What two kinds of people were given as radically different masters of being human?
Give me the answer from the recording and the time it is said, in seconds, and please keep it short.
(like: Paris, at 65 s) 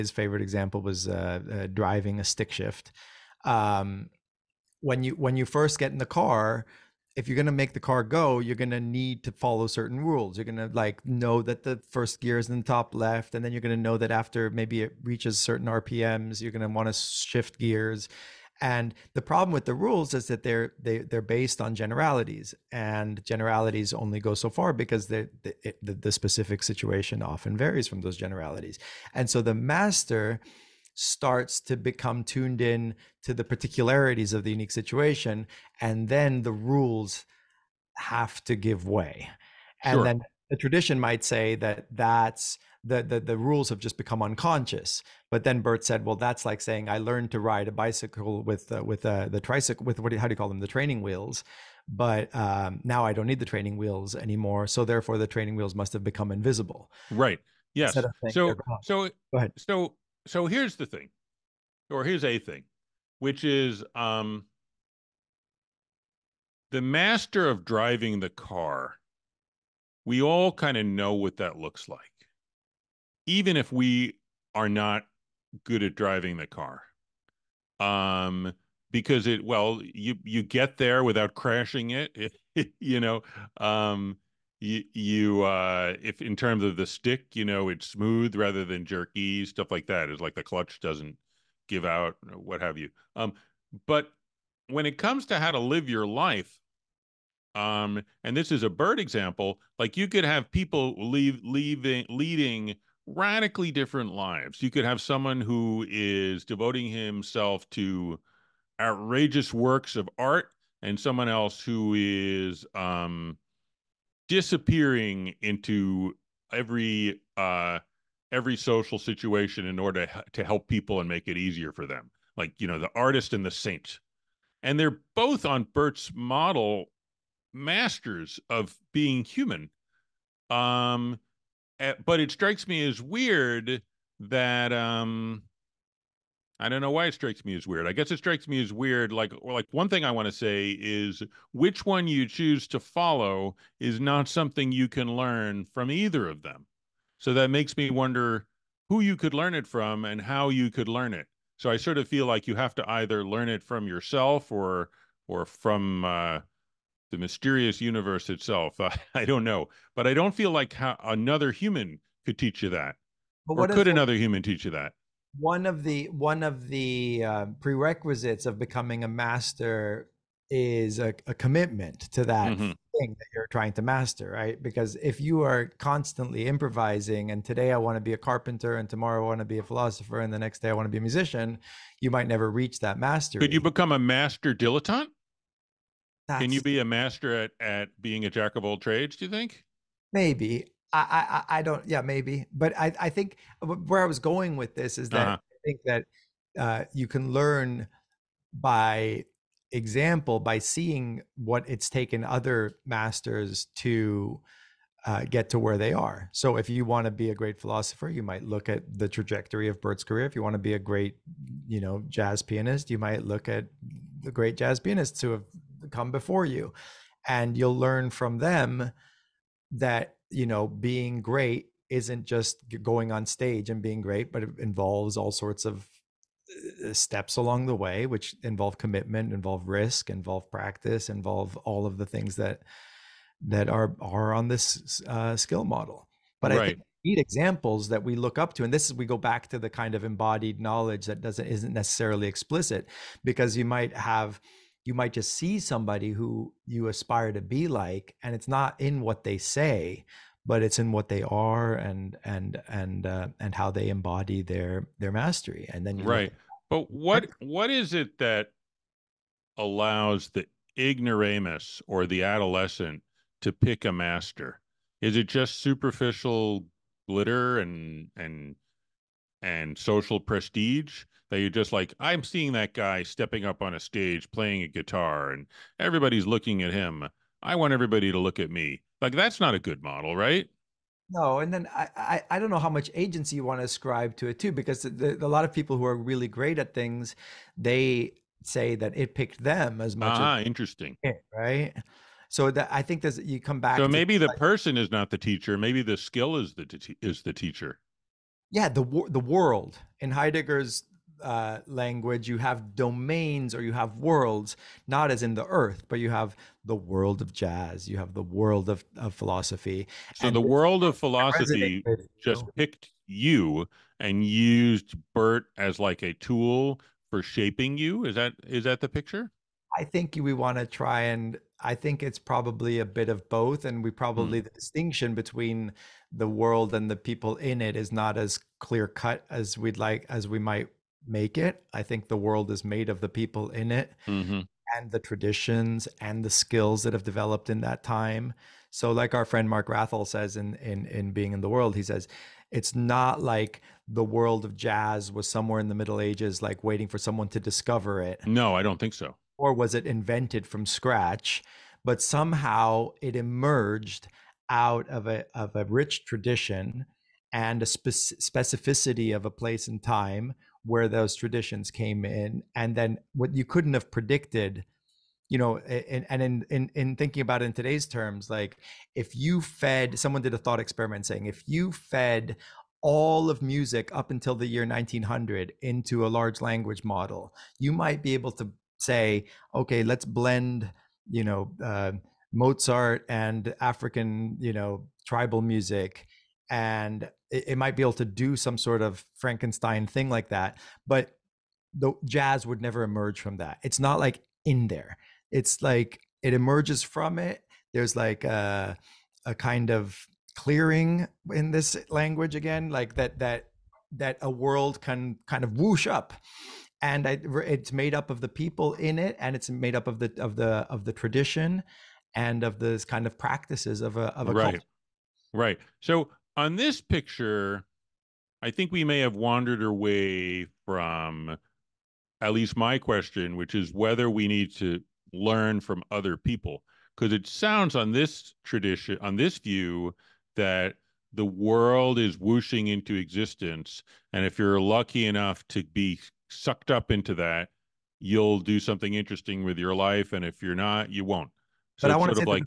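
the artist and the saint, at 122 s.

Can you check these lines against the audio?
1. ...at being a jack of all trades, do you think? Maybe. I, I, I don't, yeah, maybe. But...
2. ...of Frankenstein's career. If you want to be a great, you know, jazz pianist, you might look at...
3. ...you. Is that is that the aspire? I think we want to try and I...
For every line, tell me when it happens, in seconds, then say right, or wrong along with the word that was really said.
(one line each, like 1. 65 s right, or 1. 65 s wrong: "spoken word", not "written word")
1. 187 s right
2. 209 s wrong: "Bert", not "Frankenstein"
3. 317 s wrong: "picture", not "aspire".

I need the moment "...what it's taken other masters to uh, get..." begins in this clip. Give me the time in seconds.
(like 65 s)
201 s.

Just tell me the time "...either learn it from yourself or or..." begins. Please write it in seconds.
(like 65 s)
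152 s.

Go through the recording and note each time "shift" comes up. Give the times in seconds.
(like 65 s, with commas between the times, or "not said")
2 s, 16 s.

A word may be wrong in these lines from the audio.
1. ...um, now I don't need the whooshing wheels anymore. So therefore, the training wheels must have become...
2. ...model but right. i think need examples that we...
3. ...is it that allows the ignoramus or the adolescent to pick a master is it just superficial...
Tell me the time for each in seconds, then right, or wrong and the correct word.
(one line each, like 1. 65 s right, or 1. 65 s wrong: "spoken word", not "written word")
1. 52 s wrong: "training", not "whooshing"
2. 235 s right
3. 257 s right.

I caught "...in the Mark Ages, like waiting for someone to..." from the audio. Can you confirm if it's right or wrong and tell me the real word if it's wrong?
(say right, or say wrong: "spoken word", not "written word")
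wrong: "Middle", not "Mark".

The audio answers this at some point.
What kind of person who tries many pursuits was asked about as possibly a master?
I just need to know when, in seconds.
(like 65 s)
183 s.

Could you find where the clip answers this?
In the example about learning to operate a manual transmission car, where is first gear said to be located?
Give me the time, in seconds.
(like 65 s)
12 s.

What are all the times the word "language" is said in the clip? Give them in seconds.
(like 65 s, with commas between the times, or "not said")
301 s, 376 s, 401 s.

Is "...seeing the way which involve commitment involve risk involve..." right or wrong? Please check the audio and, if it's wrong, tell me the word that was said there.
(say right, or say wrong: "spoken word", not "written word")
wrong: "along", not "seeing".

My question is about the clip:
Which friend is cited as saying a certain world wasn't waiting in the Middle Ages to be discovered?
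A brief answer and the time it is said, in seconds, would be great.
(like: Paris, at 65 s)
Mark Wrathall, at 339 s.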